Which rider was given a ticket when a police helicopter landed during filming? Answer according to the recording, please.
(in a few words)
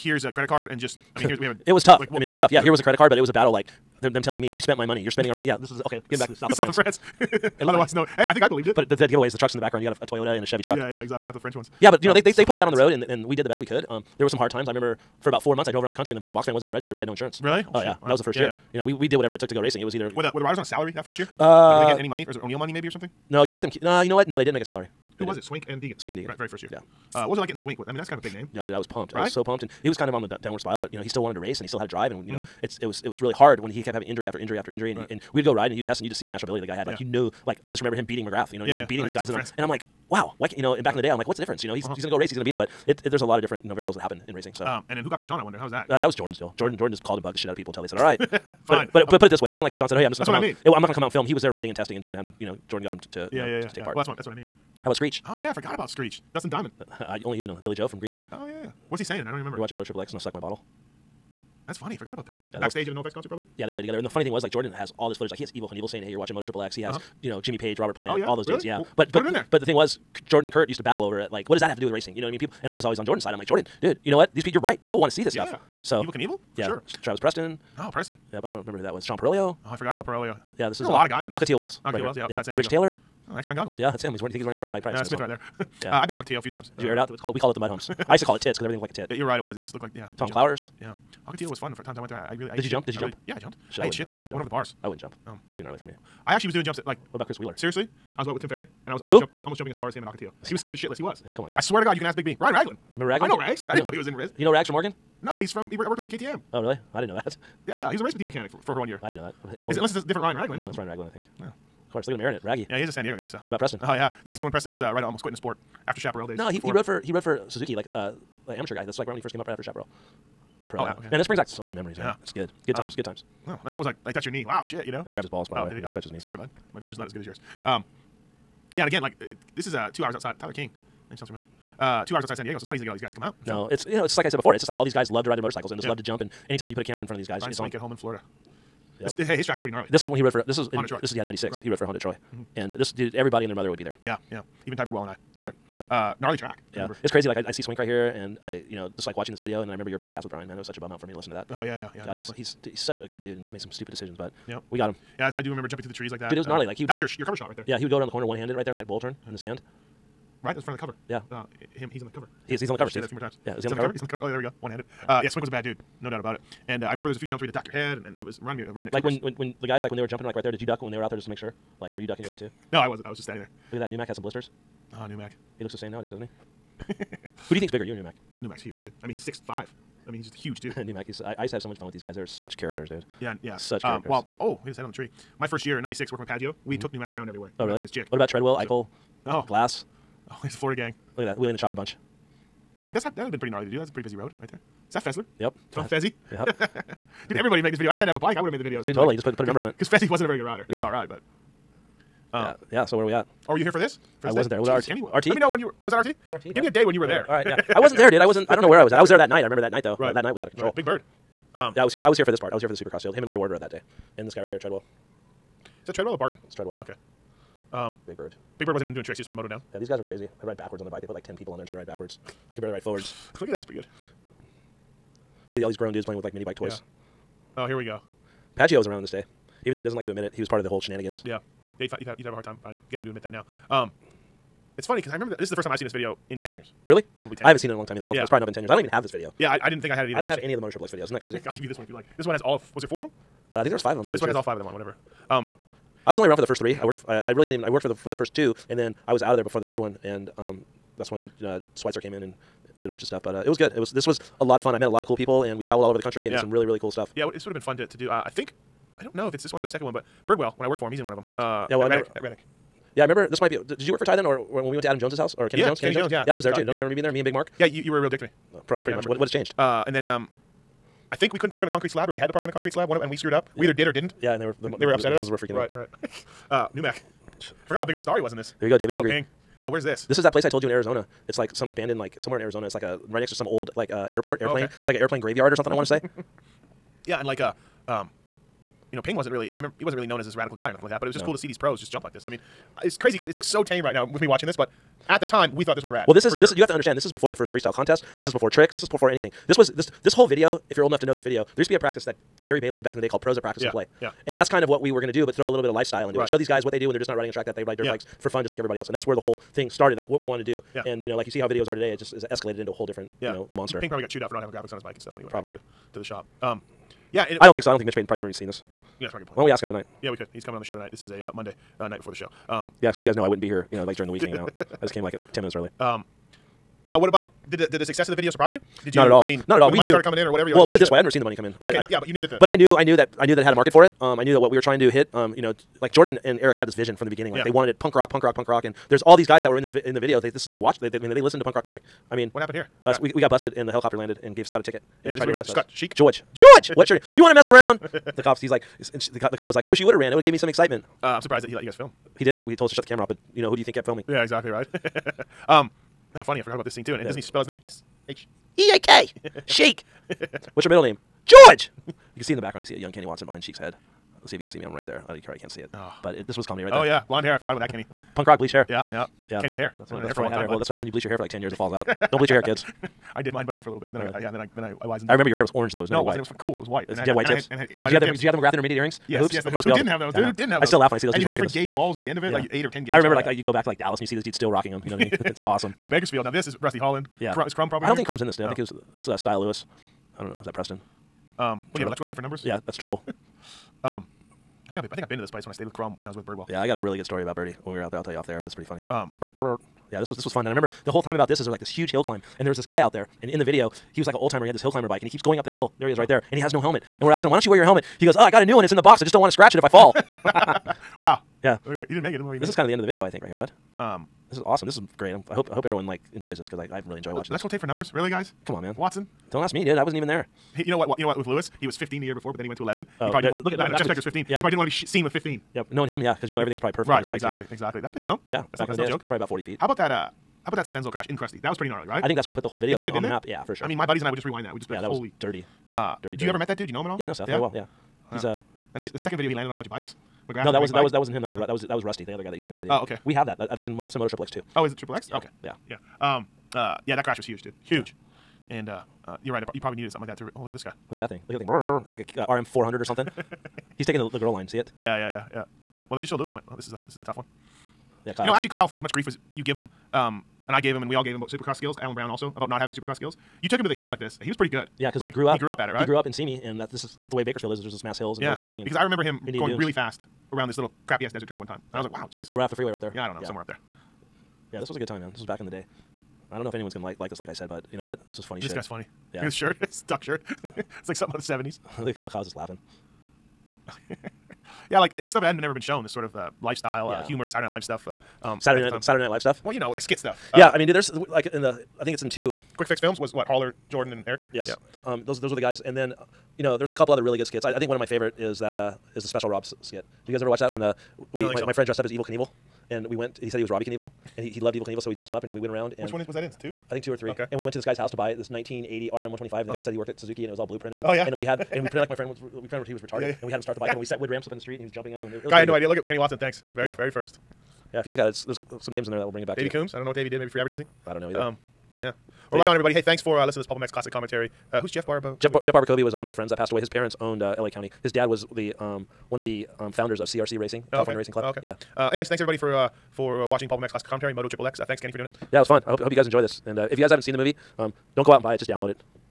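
Scott Sheak.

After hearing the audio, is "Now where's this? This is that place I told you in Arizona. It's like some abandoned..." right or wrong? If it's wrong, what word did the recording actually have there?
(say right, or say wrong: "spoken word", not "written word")
right.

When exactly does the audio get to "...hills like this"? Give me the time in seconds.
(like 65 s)
463 s.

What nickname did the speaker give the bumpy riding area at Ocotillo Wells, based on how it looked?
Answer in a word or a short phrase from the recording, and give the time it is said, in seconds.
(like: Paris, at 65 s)
tits, at 88 s.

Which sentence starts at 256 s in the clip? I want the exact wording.
did some really really cool stuff.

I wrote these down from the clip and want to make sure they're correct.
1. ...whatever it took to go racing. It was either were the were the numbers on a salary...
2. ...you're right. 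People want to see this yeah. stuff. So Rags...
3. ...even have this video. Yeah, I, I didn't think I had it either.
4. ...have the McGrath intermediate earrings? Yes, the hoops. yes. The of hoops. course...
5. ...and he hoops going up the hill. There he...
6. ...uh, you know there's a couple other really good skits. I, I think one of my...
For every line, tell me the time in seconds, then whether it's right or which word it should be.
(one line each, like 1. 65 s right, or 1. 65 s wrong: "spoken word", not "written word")
1. 19 s wrong: "riders", not "numbers"
2. 74 s wrong: "Evel", not "Rags"
3. 238 s right
4. 378 s right
5. 405 s wrong: "keeps", not "hoops"
6. 495 s right.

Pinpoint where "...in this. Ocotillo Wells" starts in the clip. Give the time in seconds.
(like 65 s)
81 s.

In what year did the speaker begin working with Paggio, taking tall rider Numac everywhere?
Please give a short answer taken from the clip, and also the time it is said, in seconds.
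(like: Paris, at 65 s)
1996, at 185 s.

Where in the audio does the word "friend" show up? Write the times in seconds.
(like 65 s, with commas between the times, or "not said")
501 s, 511 s, 526 s.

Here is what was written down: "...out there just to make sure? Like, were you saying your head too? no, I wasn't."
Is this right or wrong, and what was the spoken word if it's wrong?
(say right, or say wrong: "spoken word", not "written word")
wrong: "ducking", not "saying".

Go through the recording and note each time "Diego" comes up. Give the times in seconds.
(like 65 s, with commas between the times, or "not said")
82 s, 113 s, 132 s.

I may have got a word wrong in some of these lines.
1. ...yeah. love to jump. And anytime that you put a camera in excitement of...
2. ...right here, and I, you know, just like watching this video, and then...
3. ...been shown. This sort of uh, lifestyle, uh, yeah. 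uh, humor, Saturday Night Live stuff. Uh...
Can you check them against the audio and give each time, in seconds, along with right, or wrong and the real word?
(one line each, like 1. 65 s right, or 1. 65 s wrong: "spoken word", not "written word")
1. 135 s wrong: "front", not "excitement"
2. 147 s right
3. 485 s right.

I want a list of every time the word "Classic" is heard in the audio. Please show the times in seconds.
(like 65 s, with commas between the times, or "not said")
523 s, 533 s.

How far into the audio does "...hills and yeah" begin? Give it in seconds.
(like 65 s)
467 s.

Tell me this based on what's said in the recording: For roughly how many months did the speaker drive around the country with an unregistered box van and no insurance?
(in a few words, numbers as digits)
4.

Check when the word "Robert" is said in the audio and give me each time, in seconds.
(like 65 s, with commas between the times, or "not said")
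67 s.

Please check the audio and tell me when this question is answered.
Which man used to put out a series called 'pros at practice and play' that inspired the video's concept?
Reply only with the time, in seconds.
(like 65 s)
302 s.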